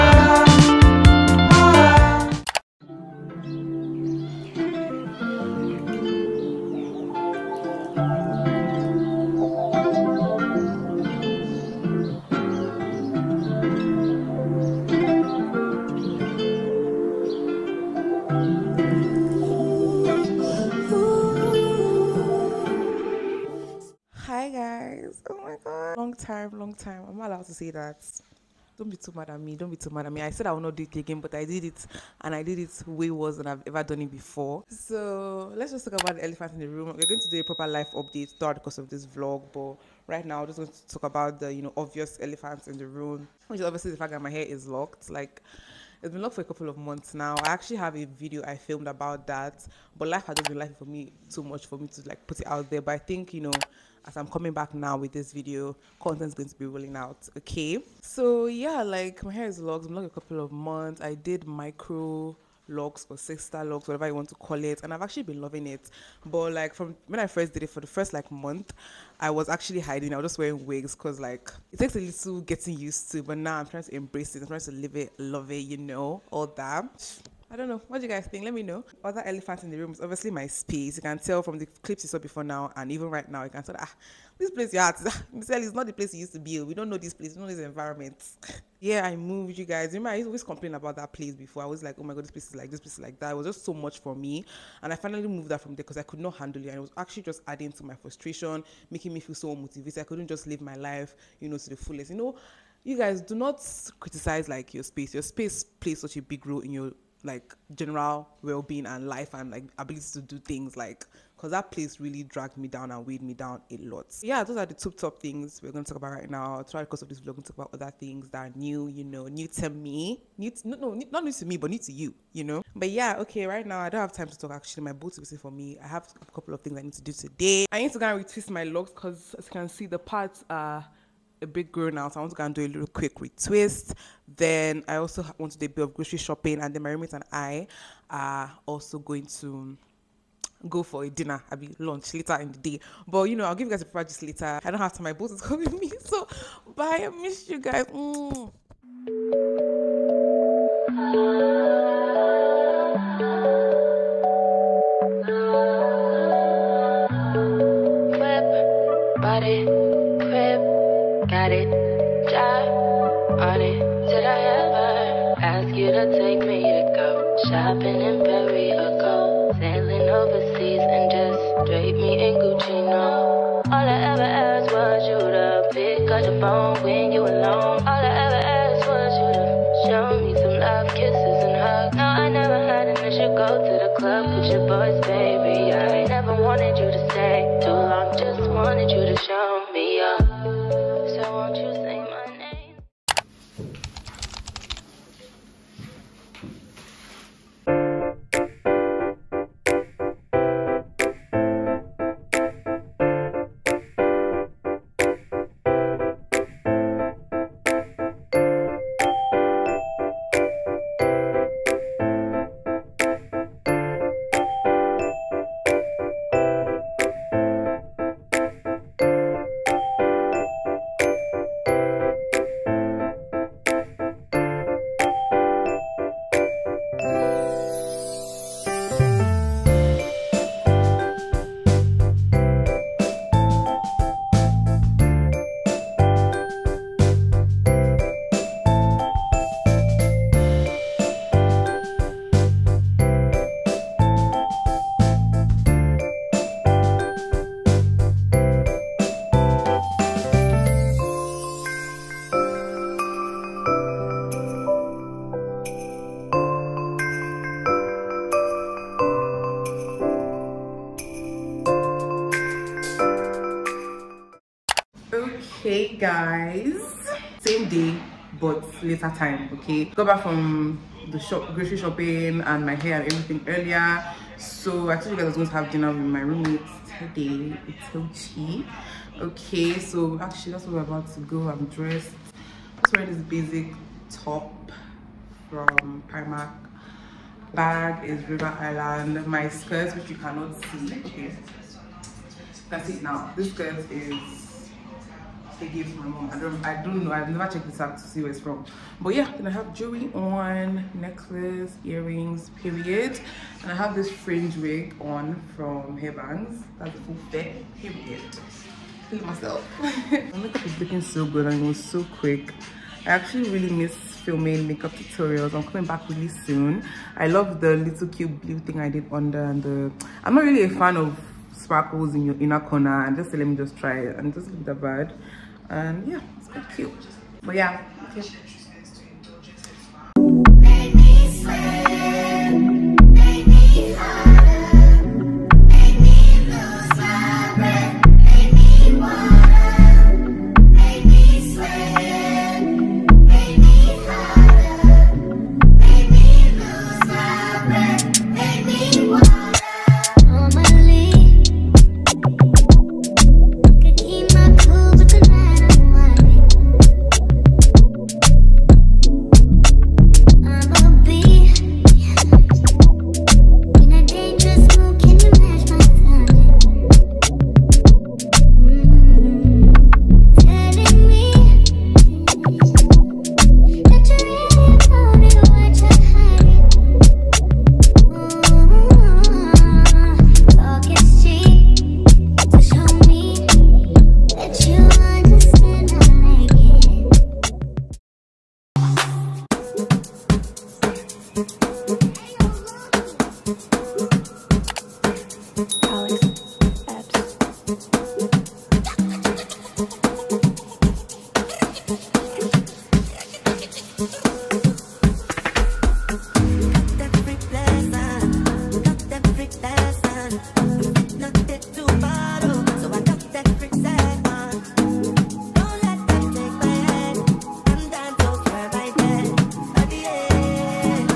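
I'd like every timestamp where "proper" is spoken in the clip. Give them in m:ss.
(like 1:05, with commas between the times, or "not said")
0:37.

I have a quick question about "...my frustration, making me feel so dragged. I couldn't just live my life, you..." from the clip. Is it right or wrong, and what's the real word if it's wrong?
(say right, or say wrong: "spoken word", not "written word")
wrong: "motivated", not "dragged".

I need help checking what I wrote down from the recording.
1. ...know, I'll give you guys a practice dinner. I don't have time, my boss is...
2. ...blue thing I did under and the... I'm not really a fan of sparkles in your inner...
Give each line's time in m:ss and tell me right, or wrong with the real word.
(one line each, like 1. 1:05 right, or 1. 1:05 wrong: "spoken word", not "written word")
1. 2:23 wrong: "later", not "dinner"
2. 5:18 right.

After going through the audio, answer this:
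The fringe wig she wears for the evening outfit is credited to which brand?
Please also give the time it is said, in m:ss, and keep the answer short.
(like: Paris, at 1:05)
Hairbands, at 5:05.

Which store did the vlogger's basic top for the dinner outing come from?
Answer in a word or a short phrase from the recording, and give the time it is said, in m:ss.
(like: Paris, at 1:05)
Primark, at 4:46.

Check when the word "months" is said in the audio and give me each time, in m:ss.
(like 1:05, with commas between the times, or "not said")
0:46, 1:00, 1:08.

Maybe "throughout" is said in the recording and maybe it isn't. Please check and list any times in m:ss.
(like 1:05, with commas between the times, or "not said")
0:38, 1:56.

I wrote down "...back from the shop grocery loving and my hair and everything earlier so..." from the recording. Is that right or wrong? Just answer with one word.
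wrong.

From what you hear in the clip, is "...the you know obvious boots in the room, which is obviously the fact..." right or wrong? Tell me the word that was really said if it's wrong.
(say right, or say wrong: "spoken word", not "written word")
wrong: "elephants", not "boots".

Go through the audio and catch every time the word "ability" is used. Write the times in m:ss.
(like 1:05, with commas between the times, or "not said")
1:49.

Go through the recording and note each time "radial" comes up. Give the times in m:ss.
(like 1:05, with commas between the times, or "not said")
not said.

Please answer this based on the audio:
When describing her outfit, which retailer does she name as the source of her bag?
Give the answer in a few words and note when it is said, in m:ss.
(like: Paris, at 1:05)
River Island, at 4:48.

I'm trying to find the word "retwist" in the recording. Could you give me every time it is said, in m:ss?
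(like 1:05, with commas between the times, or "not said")
2:08, 2:13.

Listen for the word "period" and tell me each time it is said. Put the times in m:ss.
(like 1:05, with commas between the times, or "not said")
5:02, 5:07.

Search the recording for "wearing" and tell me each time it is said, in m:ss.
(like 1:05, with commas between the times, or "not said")
1:10, 4:42.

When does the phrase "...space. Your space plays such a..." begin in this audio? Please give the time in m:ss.
1:44.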